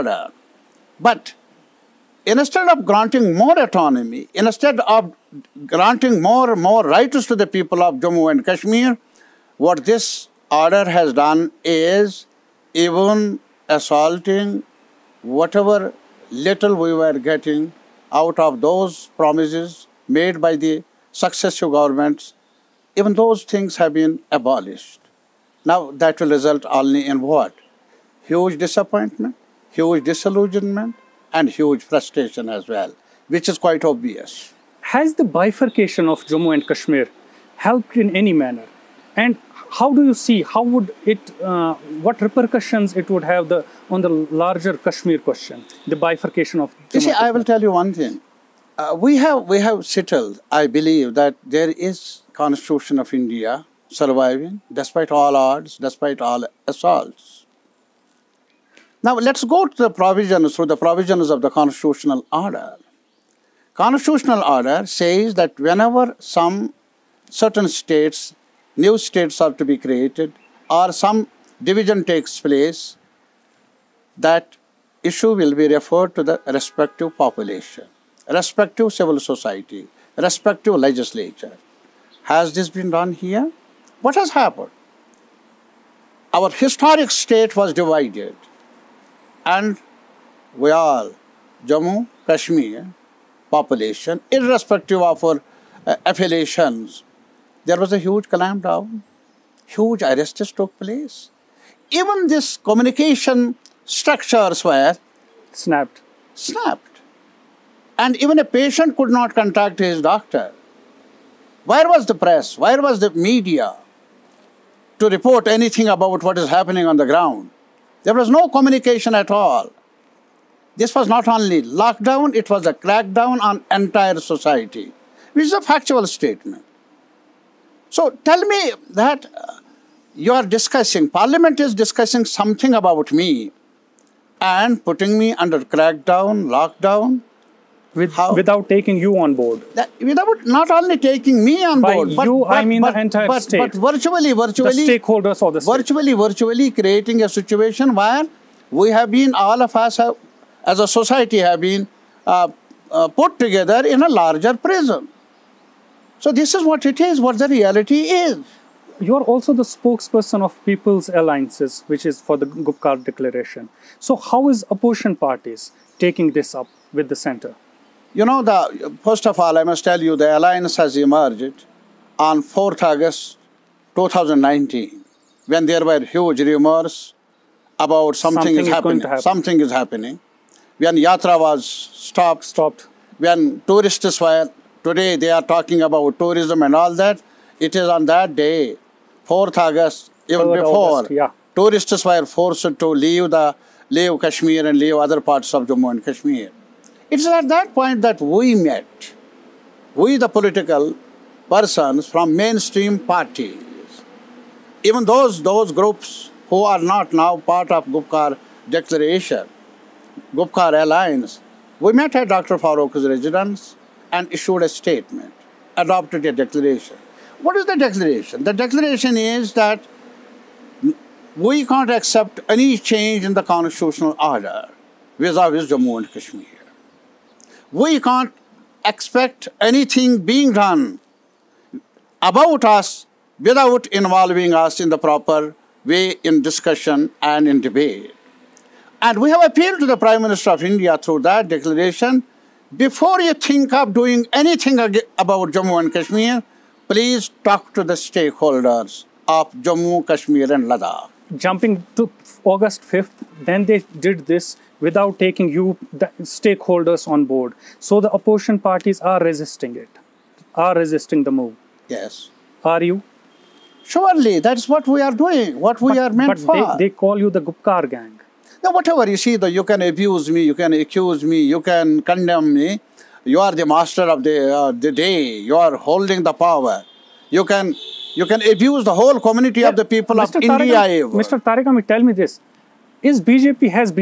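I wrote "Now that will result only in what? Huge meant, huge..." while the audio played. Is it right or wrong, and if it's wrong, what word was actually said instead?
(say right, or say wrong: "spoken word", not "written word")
wrong: "disappointment", not "meant".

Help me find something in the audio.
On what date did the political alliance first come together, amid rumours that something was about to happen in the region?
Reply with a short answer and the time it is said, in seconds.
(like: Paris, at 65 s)
4th August 2019, at 172 s.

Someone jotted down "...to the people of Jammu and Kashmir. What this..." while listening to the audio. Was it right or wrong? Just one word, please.
right.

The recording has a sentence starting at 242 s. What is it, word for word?
Before you think of doing anything about Jammu and Kashmir, please talk to the stakeholders of Jammu, Kashmir and Ladakh.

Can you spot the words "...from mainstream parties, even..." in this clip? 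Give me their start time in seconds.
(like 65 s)
202 s.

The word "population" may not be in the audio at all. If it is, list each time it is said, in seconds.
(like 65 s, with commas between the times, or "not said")
77 s, 93 s.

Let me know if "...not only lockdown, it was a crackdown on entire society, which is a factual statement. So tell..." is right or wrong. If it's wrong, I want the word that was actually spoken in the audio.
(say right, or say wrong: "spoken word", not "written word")
right.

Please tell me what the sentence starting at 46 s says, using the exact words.
Jammu you see, I will tell you one thing.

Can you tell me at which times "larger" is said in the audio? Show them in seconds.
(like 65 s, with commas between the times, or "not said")
44 s, 154 s.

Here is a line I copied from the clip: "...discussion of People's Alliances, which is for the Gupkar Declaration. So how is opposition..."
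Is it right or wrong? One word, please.
wrong.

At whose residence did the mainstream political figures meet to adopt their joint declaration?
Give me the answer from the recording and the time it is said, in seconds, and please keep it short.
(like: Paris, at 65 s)
Dr. Farooq's residence, at 212 s.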